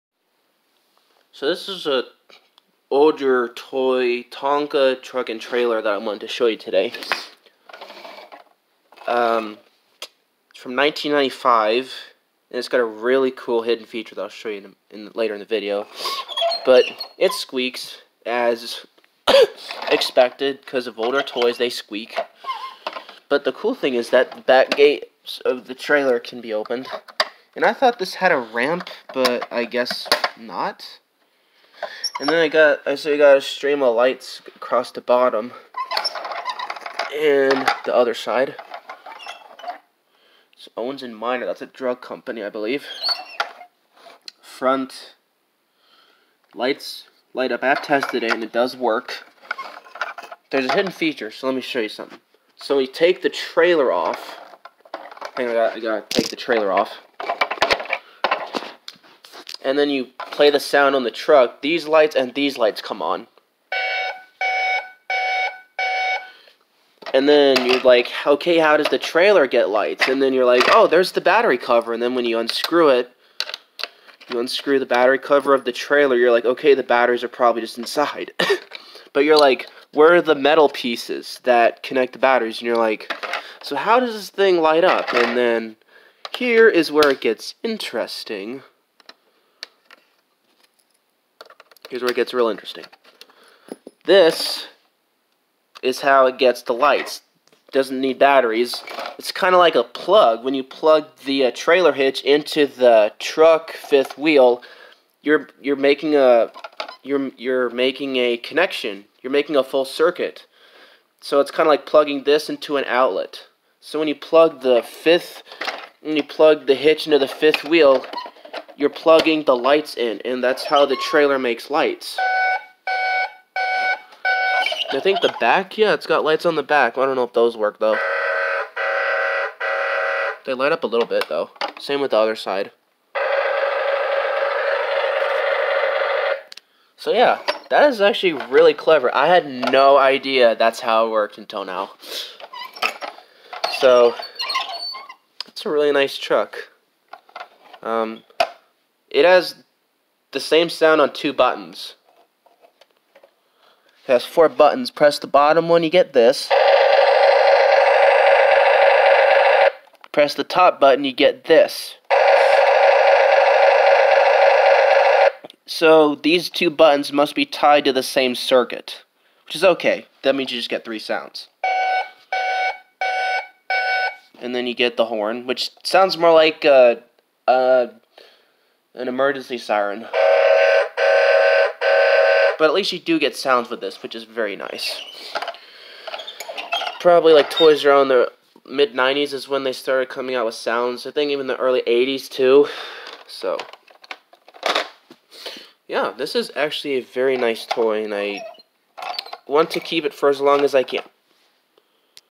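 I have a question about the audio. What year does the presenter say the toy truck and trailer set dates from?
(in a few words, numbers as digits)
1995.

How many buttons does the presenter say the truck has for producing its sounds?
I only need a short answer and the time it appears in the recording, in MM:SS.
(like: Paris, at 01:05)
4, at 02:34.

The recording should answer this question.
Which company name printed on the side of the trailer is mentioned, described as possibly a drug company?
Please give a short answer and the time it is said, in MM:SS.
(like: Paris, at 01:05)
Owens and Minor, at 00:40.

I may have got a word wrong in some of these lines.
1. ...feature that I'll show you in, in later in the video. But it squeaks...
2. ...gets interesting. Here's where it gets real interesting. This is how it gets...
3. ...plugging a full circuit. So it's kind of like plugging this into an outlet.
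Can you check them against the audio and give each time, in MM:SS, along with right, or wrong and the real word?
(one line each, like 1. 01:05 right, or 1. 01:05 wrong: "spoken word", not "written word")
1. 00:13 right
2. 01:27 right
3. 01:49 wrong: "making", not "plugging".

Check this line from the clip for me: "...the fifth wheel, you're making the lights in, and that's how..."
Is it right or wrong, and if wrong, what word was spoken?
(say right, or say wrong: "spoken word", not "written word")
wrong: "plugging", not "making".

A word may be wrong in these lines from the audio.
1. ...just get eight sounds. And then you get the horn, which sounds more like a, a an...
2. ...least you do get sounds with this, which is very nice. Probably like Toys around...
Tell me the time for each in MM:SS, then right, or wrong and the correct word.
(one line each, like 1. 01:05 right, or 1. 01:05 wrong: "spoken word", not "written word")
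1. 02:50 wrong: "three", not "eight"
2. 03:02 right.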